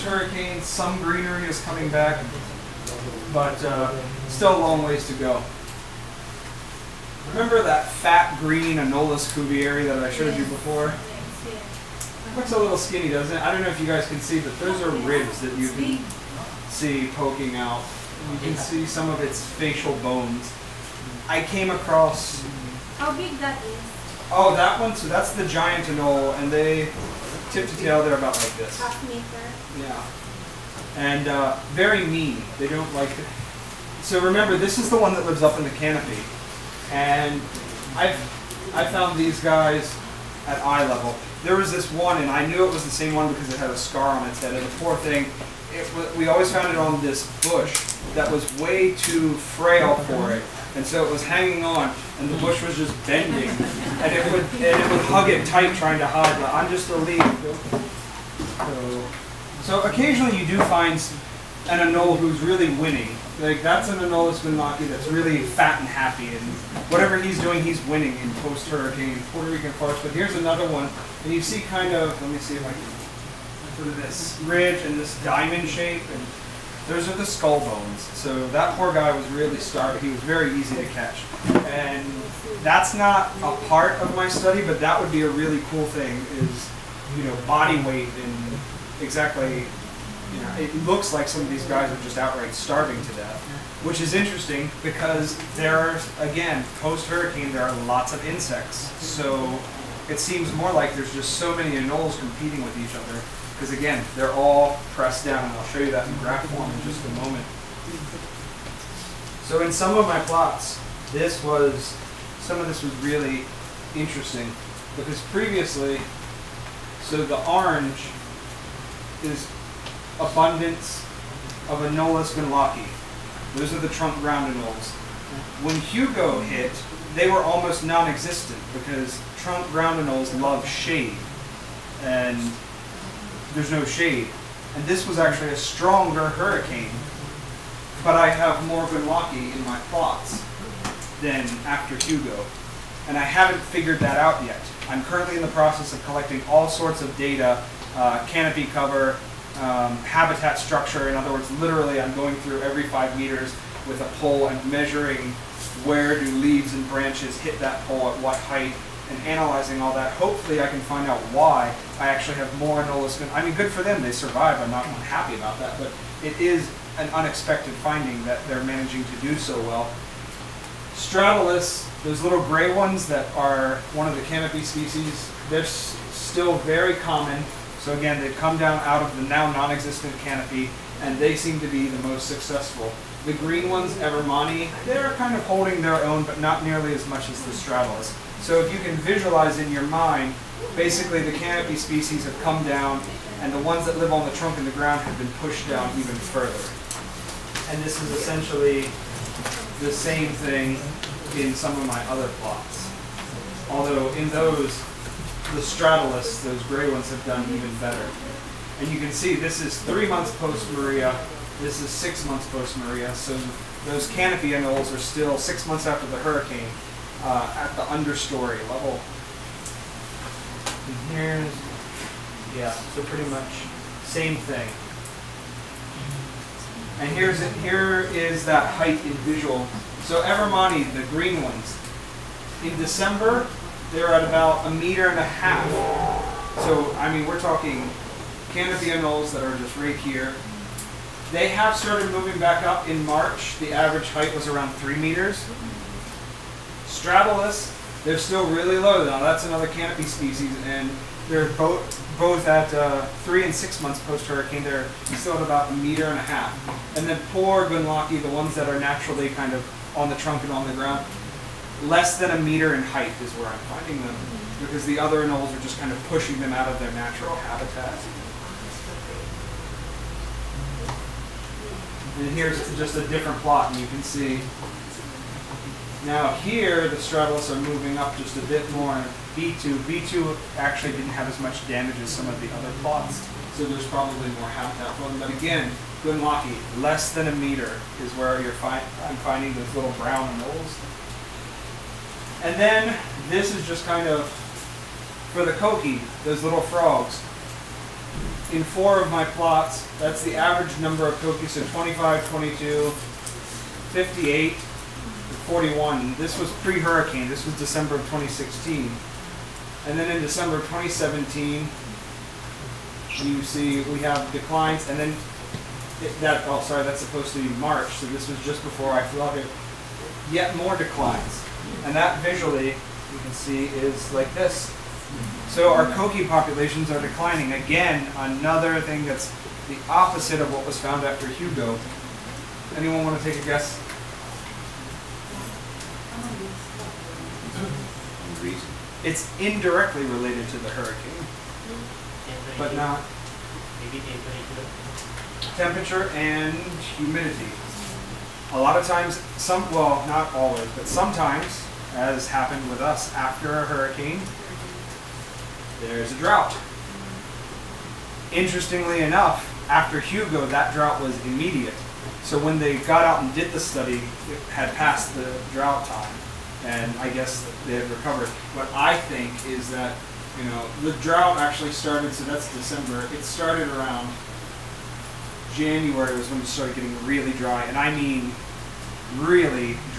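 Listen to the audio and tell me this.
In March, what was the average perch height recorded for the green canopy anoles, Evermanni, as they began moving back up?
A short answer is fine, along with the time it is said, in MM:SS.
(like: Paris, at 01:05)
3 meters, at 04:04.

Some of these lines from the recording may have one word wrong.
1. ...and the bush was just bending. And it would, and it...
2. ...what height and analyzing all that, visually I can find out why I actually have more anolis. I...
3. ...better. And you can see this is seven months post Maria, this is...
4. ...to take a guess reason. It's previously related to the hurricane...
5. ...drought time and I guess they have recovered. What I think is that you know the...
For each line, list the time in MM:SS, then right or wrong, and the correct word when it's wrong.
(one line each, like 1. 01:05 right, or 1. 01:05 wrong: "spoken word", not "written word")
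1. 00:52 right
2. 02:38 wrong: "hopefully", not "visually"
3. 03:27 wrong: "three", not "seven"
4. 05:33 wrong: "indirectly", not "previously"
5. 06:05 right.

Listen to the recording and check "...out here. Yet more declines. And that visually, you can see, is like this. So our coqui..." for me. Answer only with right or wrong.
right.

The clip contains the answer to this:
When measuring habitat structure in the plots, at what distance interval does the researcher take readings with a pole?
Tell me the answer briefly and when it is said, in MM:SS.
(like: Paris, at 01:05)
Every 5 meters, at 02:32.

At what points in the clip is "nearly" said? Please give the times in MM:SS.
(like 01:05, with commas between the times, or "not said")
03:06.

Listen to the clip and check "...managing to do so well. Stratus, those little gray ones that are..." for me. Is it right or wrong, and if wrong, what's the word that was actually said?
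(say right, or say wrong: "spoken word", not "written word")
right.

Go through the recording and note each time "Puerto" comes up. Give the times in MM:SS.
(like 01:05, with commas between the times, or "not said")
01:09.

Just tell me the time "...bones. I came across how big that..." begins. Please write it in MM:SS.
00:19.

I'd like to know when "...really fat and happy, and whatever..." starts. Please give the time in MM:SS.
01:05.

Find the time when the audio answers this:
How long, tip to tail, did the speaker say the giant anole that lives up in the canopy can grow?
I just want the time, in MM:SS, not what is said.
00:28.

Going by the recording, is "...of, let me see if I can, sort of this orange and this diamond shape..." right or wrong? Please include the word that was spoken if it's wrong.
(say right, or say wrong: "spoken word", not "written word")
wrong: "ridge", not "orange".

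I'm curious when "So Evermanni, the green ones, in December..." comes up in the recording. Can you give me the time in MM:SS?
03:50.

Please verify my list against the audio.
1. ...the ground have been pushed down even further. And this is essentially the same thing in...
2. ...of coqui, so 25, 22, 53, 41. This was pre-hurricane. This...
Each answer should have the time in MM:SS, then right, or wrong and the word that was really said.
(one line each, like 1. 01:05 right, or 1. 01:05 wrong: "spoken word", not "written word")
1. 03:14 right
2. 05:01 wrong: "58", not "53".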